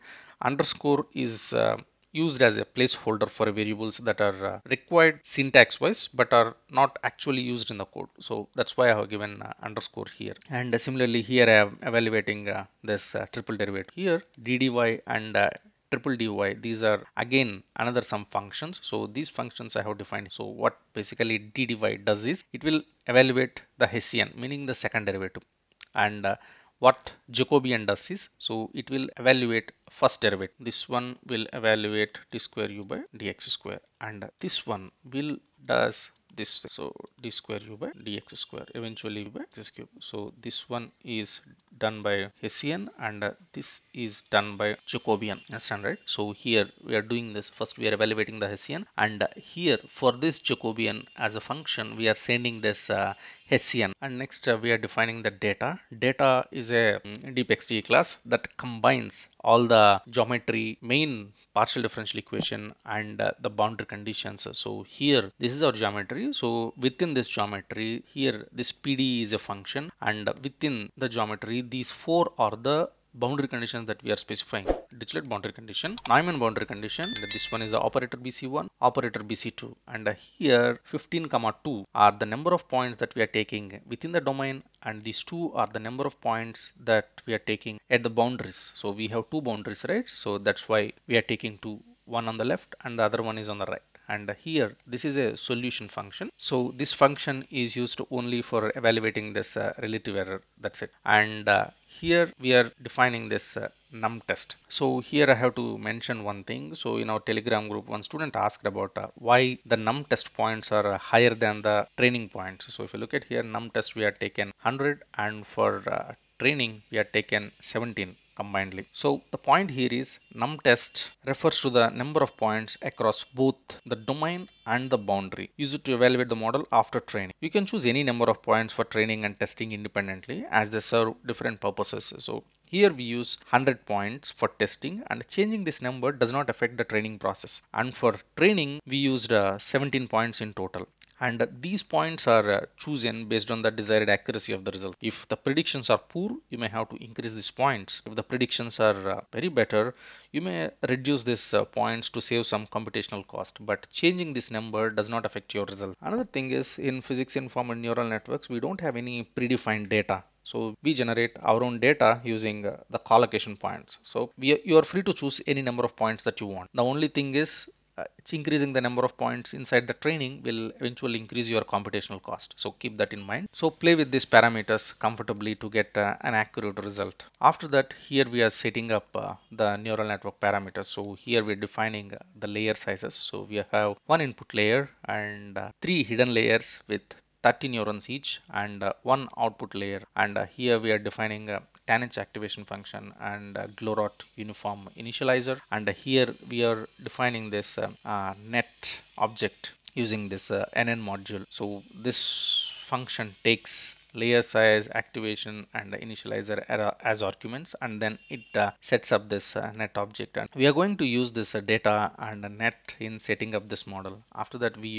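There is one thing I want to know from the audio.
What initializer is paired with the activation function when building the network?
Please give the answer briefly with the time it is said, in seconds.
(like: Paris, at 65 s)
Glorot uniform, at 193 s.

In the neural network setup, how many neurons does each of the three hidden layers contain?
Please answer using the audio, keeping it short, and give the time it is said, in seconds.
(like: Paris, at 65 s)
30, at 187 s.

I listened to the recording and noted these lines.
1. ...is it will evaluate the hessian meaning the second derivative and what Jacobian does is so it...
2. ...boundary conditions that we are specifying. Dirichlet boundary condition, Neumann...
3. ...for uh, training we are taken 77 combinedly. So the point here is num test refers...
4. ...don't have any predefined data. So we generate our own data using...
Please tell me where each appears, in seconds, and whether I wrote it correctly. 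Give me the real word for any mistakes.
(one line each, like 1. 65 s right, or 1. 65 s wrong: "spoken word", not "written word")
1. 22 s right
2. 73 s right
3. 115 s wrong: "17", not "77"
4. 158 s right.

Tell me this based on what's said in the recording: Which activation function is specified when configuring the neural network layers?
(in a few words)
tanh.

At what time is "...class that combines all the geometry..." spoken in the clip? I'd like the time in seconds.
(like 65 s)
57 s.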